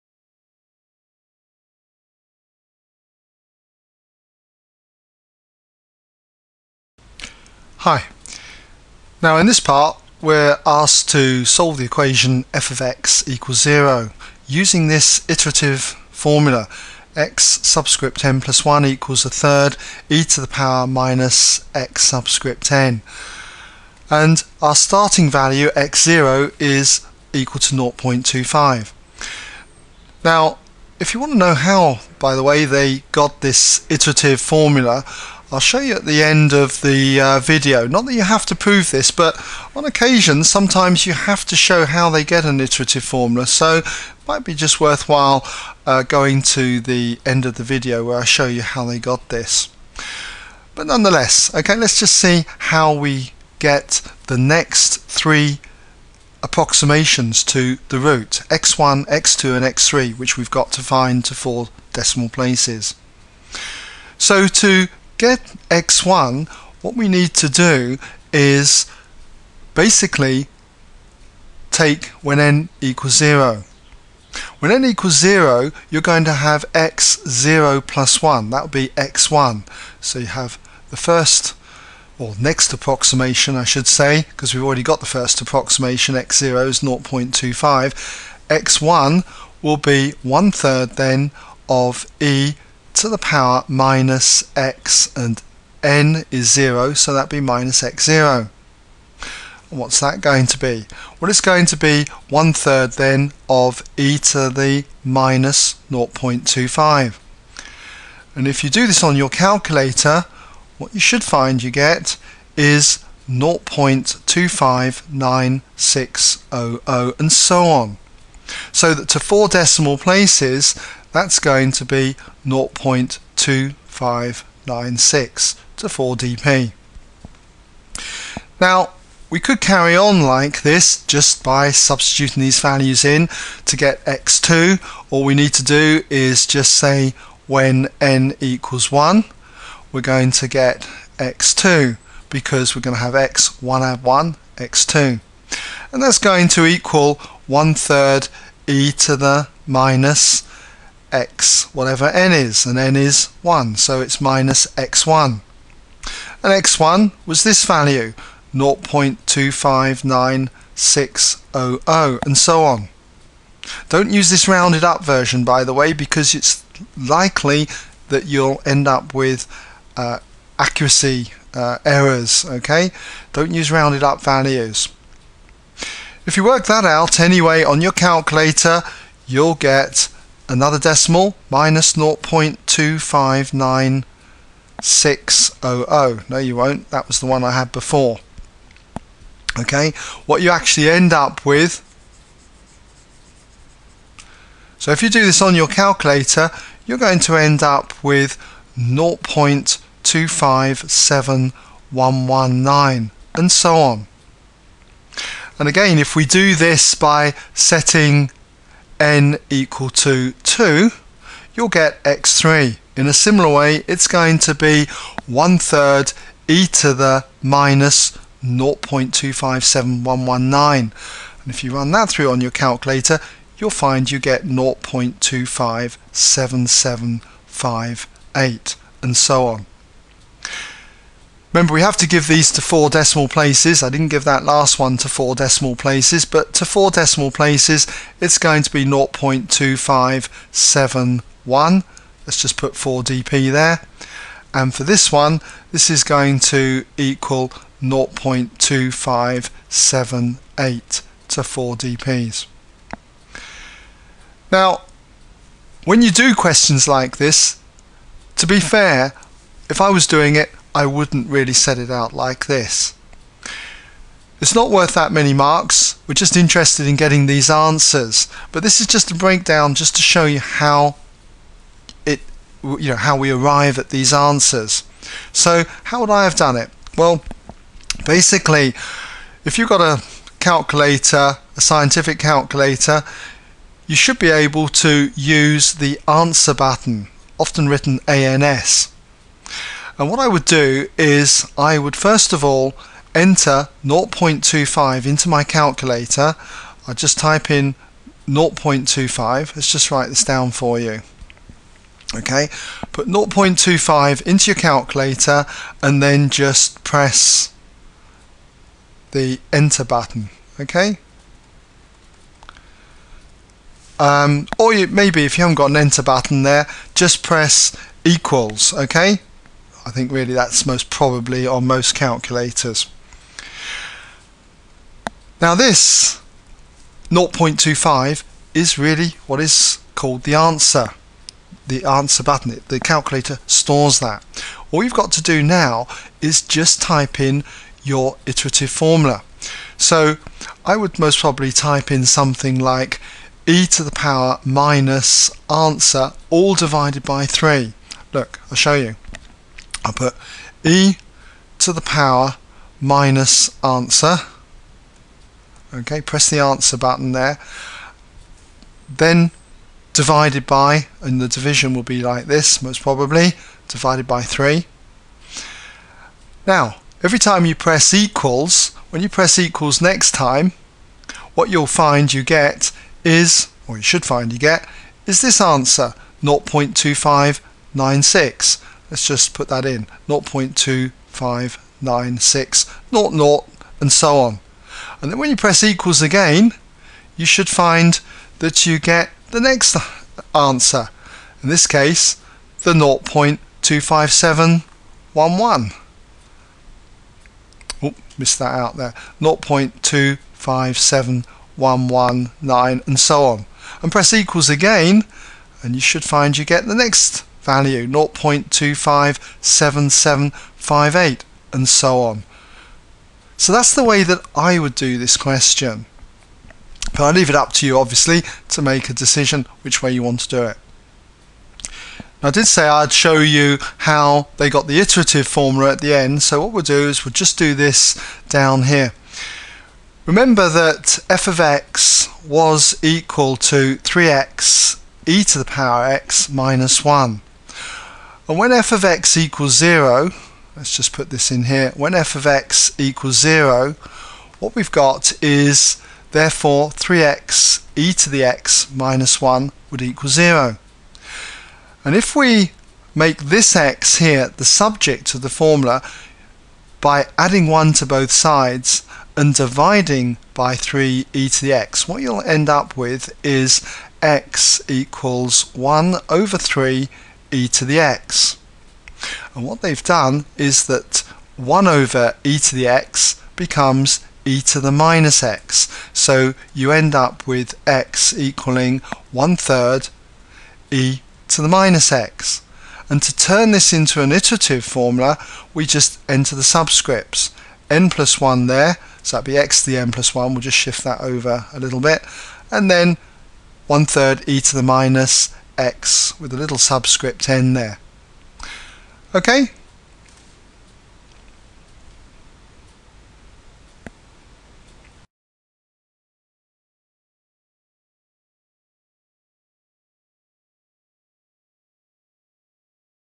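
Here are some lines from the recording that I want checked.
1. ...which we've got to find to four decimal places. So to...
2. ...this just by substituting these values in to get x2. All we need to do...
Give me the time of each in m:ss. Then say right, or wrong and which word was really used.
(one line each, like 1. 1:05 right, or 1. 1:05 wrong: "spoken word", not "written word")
1. 1:00 right
2. 2:10 right.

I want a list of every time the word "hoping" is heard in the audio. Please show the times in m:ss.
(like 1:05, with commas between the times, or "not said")
not said.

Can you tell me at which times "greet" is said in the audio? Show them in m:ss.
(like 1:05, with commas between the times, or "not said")
not said.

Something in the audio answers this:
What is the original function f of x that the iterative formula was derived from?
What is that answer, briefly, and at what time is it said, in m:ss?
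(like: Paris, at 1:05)
3x e^x - 1, at 7:13.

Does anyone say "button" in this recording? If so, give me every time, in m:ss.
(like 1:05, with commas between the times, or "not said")
4:46, 5:09, 5:16, 5:32, 5:56.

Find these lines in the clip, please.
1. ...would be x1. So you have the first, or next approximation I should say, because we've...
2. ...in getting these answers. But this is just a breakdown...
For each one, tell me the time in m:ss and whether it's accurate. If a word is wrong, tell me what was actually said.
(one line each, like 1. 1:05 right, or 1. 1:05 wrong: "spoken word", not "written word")
1. 1:18 right
2. 4:26 right.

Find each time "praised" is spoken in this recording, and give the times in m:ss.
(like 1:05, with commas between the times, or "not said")
not said.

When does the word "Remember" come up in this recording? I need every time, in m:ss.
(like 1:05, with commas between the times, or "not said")
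3:51, 7:10.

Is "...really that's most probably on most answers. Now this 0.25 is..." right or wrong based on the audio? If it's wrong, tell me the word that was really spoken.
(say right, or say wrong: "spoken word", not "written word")
wrong: "calculators", not "answers".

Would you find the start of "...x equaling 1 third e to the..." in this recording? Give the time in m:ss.
7:57.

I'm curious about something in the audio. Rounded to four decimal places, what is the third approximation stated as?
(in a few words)
0.2578.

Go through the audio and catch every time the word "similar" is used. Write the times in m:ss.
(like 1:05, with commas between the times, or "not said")
3:33.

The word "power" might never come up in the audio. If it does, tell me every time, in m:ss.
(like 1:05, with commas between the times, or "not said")
0:20, 1:33, 5:43, 5:51, 7:15.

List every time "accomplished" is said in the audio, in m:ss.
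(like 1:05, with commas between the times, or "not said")
not said.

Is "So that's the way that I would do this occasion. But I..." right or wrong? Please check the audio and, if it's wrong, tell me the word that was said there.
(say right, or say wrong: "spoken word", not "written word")
wrong: "question", not "occasion".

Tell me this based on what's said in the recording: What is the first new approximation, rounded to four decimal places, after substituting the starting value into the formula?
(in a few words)
0.2596.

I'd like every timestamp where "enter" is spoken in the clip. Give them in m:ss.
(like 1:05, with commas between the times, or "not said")
4:53, 5:09, 5:15, 8:06.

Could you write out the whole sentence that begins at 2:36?
And x1 was this value, 0.259600, and so on.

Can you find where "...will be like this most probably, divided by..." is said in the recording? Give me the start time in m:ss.
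6:01.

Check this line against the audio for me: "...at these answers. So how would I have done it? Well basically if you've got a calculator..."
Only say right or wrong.
right.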